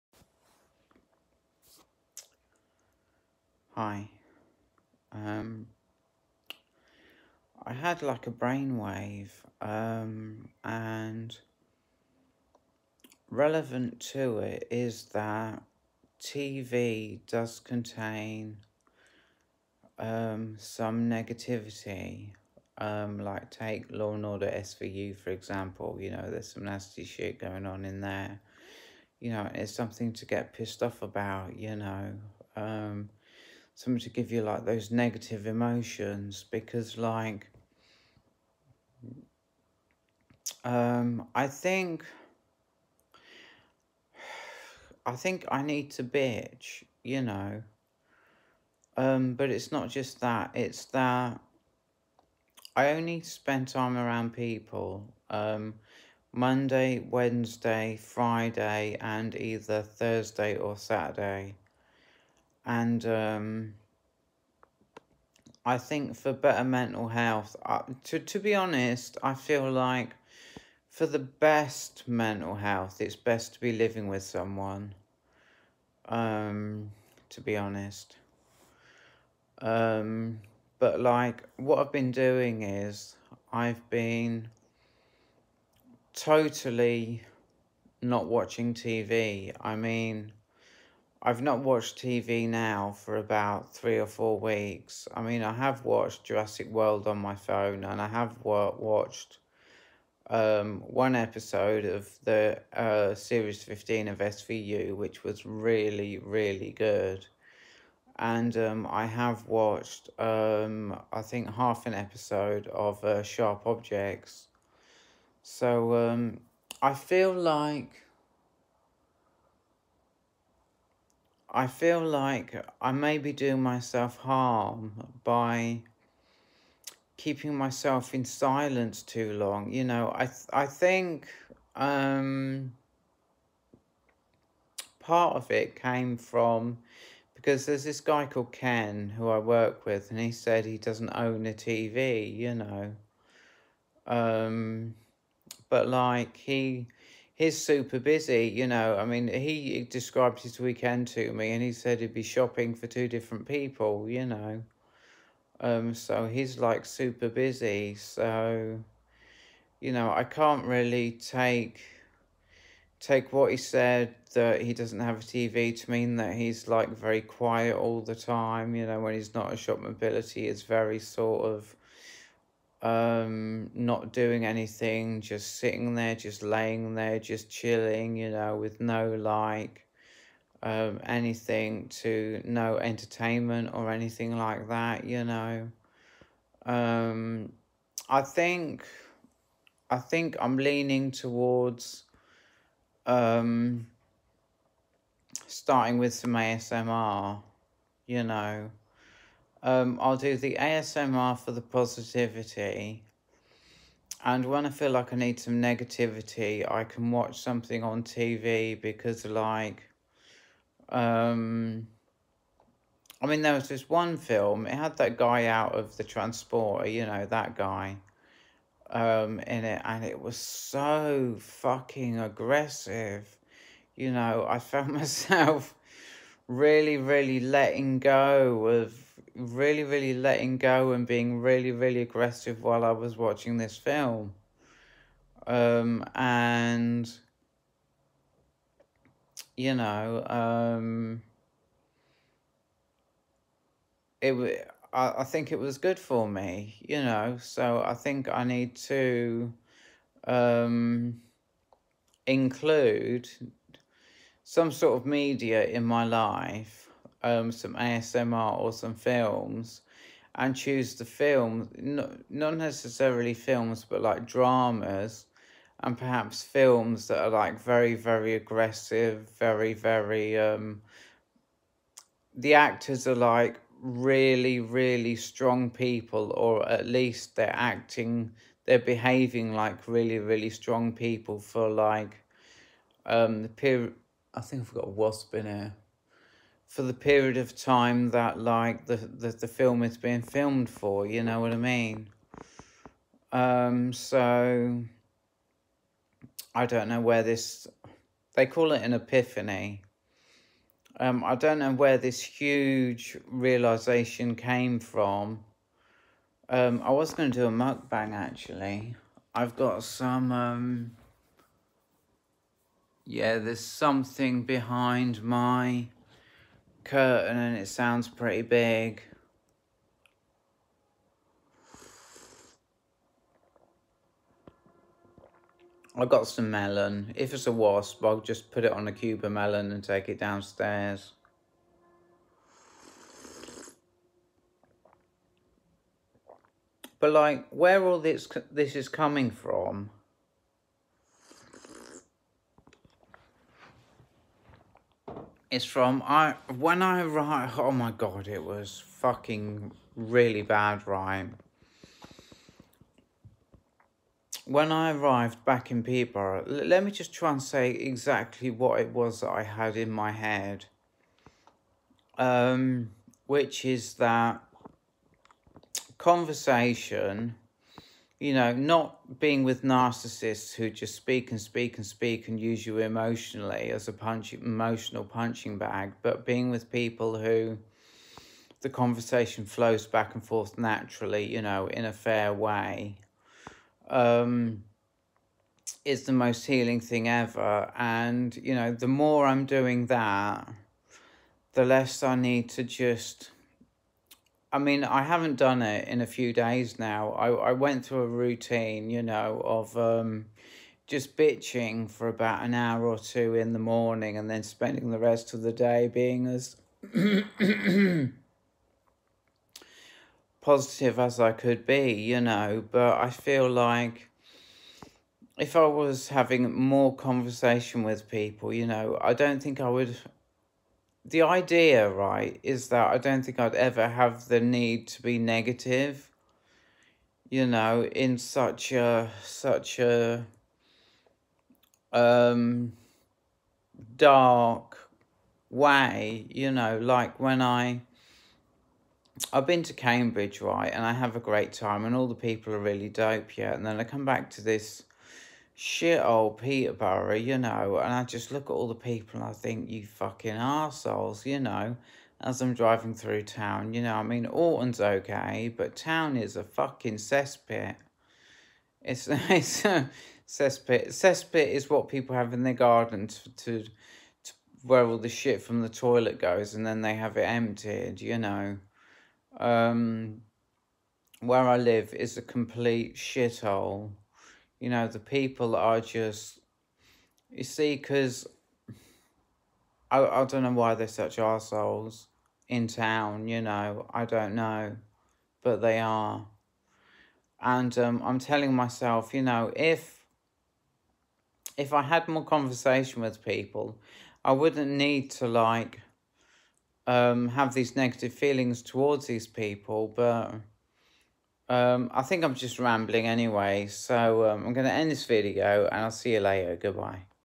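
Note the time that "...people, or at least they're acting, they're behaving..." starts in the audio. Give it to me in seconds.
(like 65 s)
275 s.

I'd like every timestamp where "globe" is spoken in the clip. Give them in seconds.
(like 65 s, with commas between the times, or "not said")
not said.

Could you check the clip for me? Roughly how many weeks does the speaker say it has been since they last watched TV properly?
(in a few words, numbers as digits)
3 or 4 weeks.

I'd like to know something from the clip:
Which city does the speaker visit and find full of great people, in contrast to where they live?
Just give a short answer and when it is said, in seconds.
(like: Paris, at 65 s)
Cambridge, at 439 s.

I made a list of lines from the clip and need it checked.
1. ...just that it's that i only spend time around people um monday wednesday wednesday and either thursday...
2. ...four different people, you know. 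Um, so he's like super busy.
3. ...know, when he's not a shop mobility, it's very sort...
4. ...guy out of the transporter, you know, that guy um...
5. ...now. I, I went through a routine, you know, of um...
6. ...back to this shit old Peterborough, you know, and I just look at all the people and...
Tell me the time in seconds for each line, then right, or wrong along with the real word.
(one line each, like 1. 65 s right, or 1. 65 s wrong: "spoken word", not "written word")
1. 49 s wrong: "friday", not "wednesday"
2. 152 s wrong: "two", not "four"
3. 168 s right
4. 215 s right
5. 396 s right
6. 444 s right.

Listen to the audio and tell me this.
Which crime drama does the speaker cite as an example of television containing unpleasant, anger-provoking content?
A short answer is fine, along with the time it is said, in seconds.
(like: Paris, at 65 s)
Law and Order SVU, at 23 s.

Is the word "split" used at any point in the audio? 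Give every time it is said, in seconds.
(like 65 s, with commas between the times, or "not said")
not said.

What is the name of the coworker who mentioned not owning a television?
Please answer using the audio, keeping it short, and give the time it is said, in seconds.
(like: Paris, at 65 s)
Ken, at 138 s.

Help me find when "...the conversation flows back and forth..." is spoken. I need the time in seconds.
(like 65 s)
378 s.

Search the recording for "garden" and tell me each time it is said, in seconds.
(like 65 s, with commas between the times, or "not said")
462 s.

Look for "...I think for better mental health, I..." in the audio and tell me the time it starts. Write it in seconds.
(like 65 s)
65 s.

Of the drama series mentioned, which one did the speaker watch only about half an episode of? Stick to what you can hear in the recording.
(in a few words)
Sharp Objects.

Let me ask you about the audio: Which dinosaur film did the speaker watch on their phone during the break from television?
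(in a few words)
Jurassic World.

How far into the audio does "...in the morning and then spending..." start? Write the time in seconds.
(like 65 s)
403 s.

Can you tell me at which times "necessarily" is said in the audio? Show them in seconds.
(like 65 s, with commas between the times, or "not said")
262 s.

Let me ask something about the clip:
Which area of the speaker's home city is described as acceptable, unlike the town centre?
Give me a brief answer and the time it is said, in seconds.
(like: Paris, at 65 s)
Orton, at 454 s.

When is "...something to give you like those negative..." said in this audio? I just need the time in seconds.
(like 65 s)
33 s.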